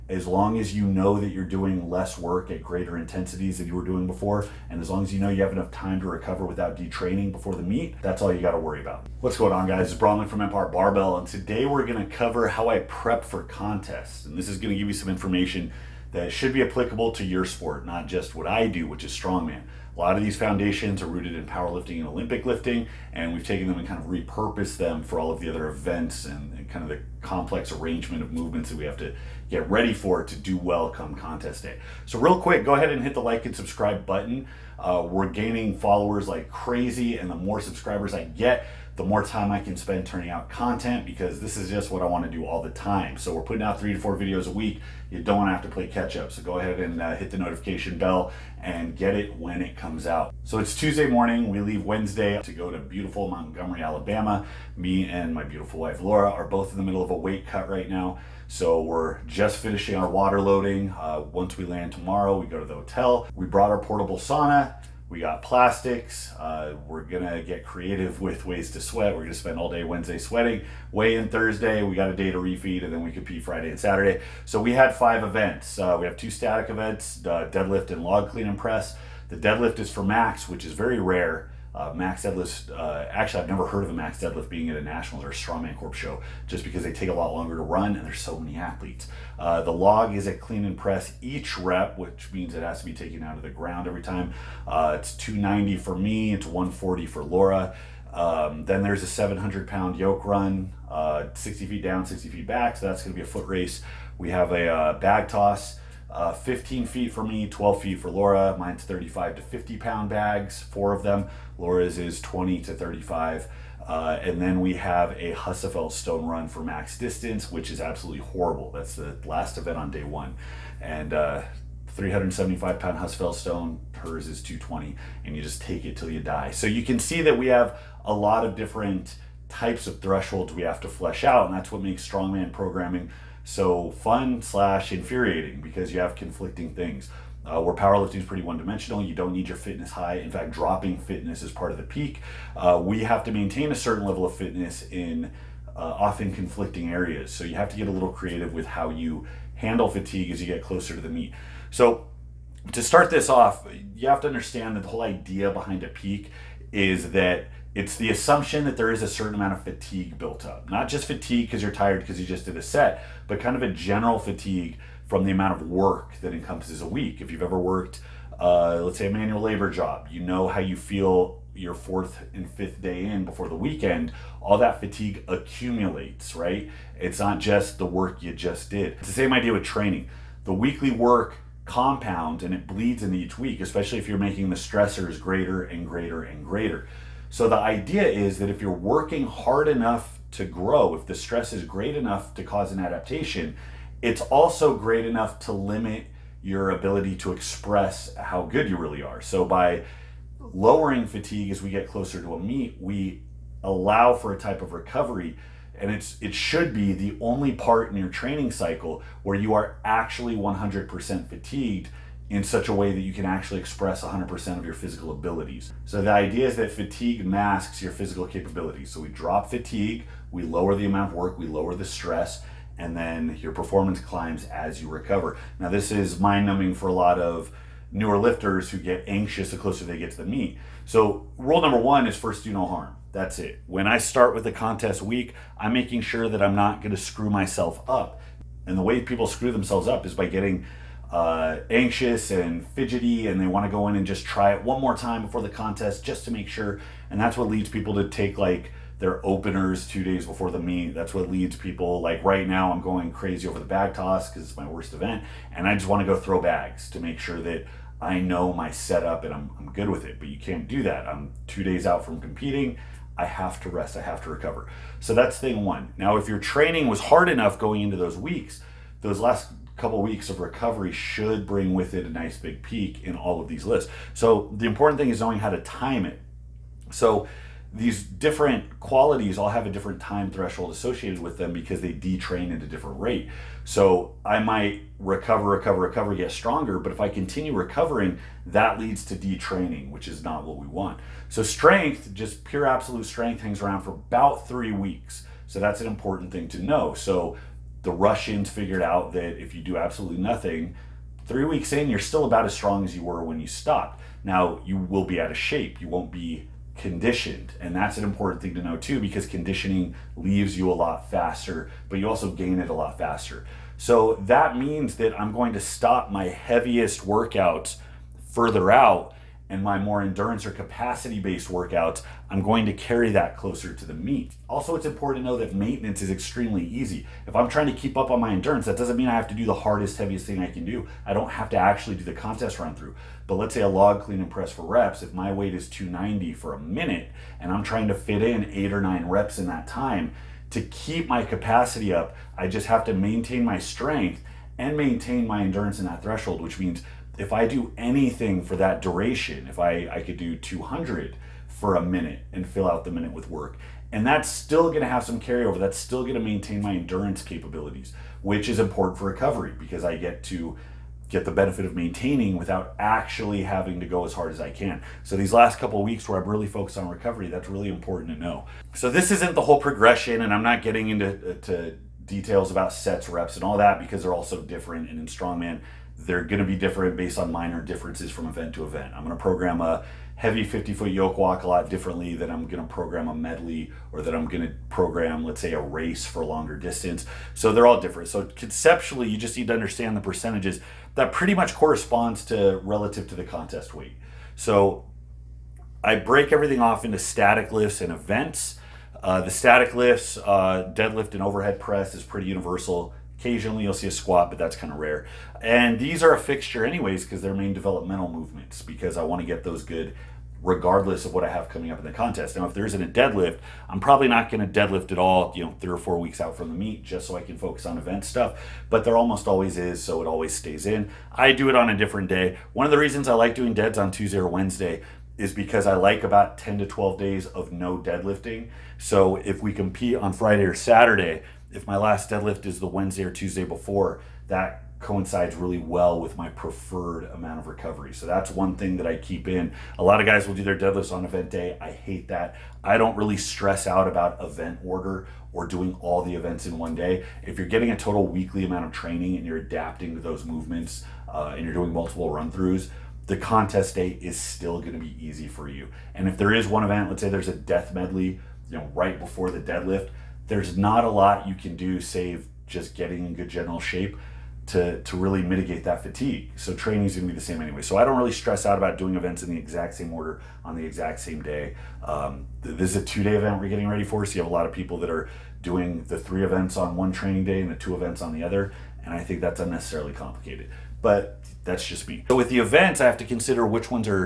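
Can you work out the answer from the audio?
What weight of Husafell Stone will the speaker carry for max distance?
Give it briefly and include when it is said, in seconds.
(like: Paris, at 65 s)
375 pounds, at 121 s.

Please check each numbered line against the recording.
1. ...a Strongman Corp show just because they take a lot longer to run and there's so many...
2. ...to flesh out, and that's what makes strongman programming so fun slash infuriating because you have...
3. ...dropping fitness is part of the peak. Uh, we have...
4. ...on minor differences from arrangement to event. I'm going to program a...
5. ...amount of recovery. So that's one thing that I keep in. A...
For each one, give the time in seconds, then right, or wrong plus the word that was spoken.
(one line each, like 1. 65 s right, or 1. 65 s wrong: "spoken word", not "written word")
1. 85 s right
2. 130 s right
3. 140 s right
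4. 377 s wrong: "event", not "arrangement"
5. 437 s right.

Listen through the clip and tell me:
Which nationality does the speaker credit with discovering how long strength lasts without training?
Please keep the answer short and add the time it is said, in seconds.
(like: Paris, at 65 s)
Russians, at 297 s.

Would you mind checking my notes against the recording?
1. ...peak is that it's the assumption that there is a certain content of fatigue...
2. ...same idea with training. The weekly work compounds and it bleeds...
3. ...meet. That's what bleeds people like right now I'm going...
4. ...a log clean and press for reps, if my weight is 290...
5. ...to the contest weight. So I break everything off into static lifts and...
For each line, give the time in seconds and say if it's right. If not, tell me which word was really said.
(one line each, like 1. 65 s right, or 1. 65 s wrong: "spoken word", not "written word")
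1. 155 s wrong: "amount", not "content"
2. 179 s right
3. 250 s wrong: "leads", not "bleeds"
4. 333 s right
5. 393 s right.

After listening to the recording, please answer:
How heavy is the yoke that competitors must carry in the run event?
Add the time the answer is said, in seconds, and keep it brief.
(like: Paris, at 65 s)
700 pounds, at 99 s.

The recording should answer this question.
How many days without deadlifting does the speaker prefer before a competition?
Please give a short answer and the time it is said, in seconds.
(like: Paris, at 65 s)
10 to 12 days, at 426 s.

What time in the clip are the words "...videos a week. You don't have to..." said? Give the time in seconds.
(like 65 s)
44 s.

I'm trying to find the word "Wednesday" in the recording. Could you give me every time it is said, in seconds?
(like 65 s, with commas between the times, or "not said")
51 s, 69 s, 424 s, 432 s.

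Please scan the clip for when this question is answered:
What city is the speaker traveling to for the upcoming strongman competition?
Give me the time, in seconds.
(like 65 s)
53 s.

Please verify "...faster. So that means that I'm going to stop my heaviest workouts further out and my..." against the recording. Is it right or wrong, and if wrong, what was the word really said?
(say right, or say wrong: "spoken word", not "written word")
right.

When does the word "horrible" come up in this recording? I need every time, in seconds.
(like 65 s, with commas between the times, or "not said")
118 s.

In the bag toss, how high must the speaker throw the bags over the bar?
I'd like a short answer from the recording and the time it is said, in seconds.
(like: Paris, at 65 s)
15 feet, at 106 s.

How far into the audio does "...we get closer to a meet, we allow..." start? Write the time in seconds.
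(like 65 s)
201 s.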